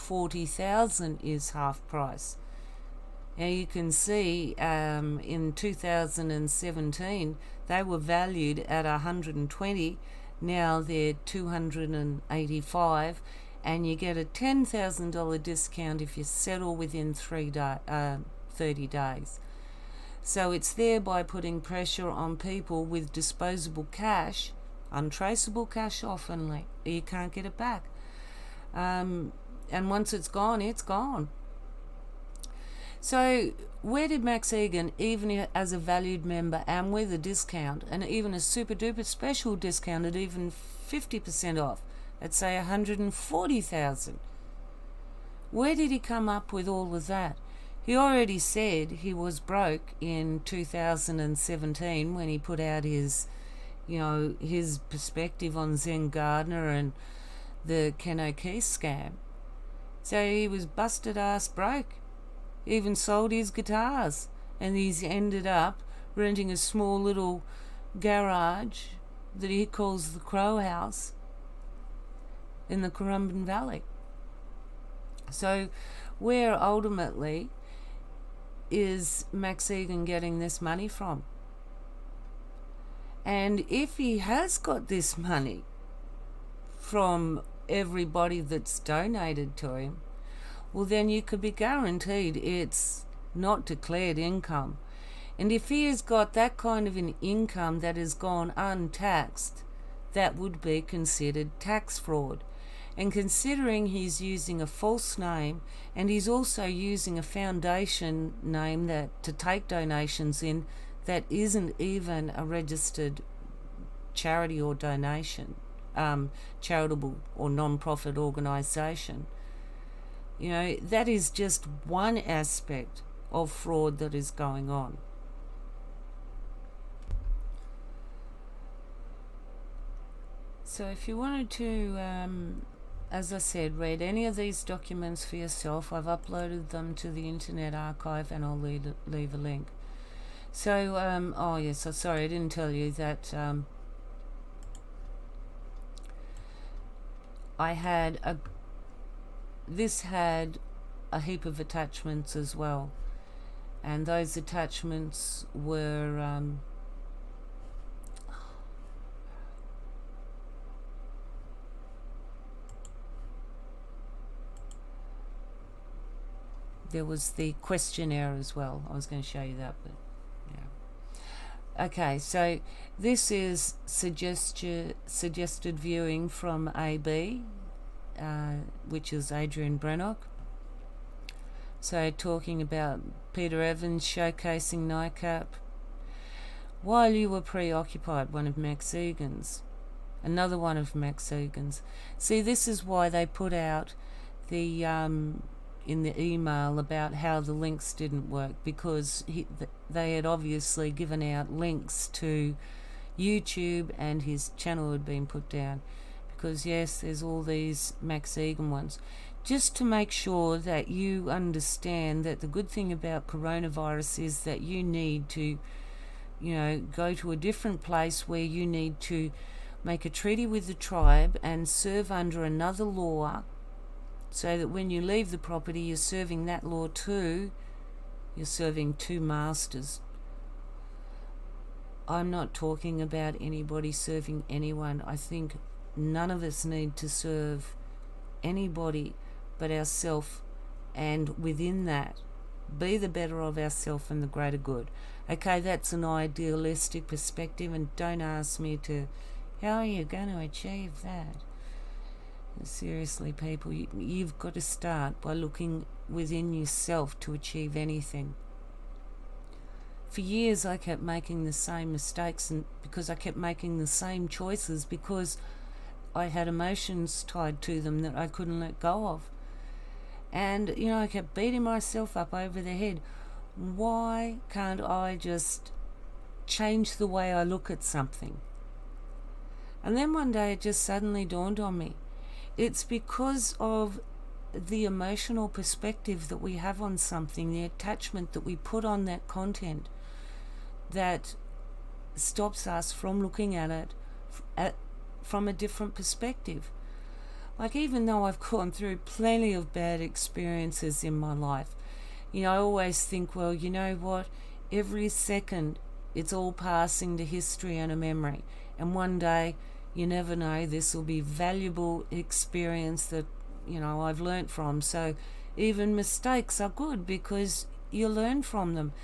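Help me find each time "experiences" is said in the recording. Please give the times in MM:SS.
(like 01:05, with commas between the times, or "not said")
05:00, 05:12.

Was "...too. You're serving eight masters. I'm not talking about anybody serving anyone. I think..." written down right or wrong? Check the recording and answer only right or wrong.
wrong.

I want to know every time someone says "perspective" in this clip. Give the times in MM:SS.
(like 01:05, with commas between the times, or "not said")
00:54, 04:07, 04:45, 04:55.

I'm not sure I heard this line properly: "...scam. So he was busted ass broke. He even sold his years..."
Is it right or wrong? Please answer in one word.
wrong.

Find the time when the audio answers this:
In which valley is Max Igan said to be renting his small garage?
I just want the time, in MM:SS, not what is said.
01:12.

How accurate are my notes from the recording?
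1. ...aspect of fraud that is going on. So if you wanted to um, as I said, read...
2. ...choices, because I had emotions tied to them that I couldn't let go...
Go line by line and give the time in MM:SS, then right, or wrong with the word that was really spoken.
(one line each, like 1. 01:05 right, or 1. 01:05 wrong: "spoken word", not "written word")
1. 02:02 right
2. 04:24 right.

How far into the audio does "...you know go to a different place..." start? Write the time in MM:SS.
03:36.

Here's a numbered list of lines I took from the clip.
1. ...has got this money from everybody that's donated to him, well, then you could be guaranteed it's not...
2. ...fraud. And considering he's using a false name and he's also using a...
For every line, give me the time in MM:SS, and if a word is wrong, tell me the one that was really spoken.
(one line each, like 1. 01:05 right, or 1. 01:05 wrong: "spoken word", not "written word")
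1. 01:24 right
2. 01:41 right.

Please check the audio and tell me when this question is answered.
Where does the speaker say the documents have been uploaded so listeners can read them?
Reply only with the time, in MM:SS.
02:17.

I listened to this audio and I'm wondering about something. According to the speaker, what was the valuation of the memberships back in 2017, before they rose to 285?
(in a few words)
120.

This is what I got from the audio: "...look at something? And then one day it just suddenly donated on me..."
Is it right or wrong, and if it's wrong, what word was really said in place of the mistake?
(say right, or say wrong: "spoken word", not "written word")
wrong: "dawned", not "donated".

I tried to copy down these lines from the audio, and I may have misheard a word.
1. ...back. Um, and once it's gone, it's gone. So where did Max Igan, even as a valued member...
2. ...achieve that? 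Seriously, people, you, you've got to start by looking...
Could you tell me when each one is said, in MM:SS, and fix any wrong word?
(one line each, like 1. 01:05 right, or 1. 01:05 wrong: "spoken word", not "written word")
1. 00:27 right
2. 04:10 right.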